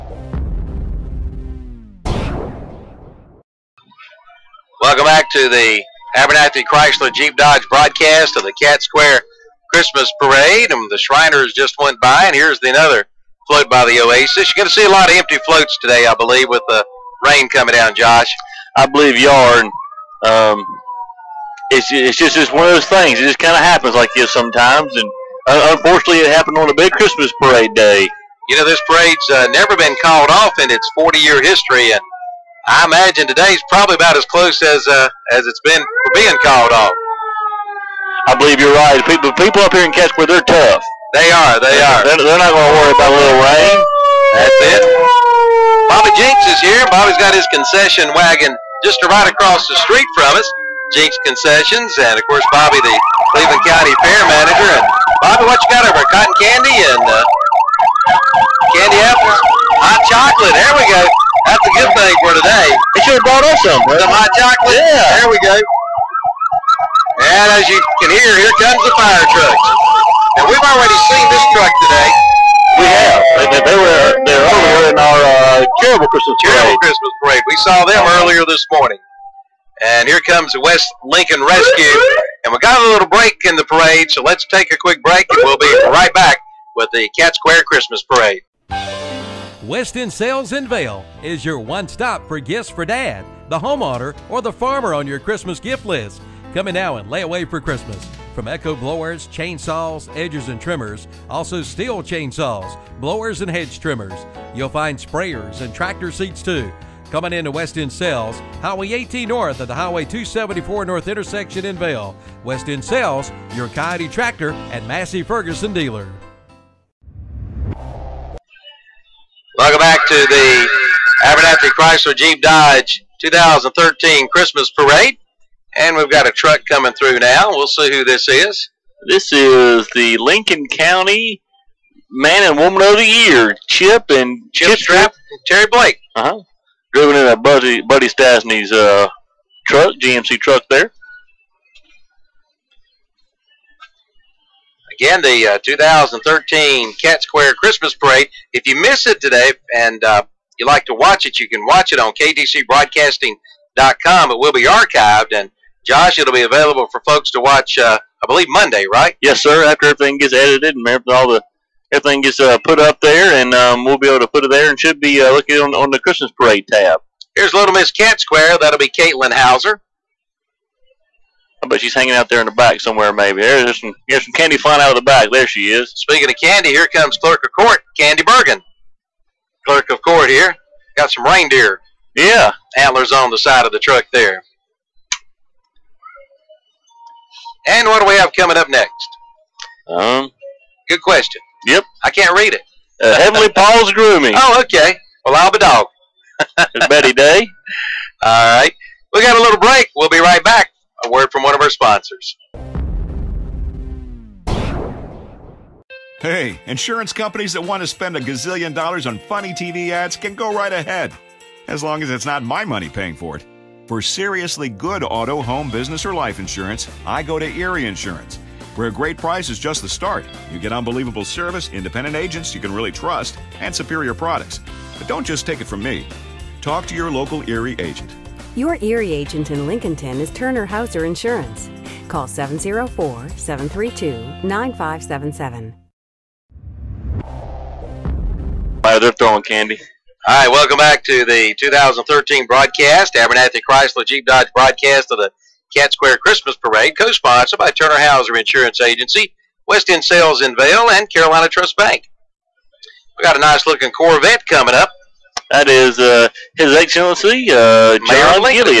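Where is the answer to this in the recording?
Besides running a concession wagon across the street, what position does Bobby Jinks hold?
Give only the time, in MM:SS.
00:52.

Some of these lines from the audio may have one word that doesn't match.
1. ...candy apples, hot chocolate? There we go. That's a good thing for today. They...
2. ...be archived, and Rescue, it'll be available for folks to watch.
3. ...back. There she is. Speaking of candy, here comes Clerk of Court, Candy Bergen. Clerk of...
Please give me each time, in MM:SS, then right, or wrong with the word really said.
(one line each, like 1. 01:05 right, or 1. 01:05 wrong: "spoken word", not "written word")
1. 00:58 right
2. 02:34 wrong: "Josh", not "Rescue"
3. 02:55 right.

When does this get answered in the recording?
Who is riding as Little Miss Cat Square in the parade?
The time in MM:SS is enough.
02:48.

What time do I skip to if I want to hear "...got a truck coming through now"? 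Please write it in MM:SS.
02:06.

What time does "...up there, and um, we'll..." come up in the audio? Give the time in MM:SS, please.
02:42.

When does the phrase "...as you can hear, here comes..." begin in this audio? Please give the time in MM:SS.
01:07.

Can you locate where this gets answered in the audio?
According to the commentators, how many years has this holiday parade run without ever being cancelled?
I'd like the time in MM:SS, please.
00:30.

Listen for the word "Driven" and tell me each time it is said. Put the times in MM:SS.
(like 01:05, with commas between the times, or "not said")
02:16.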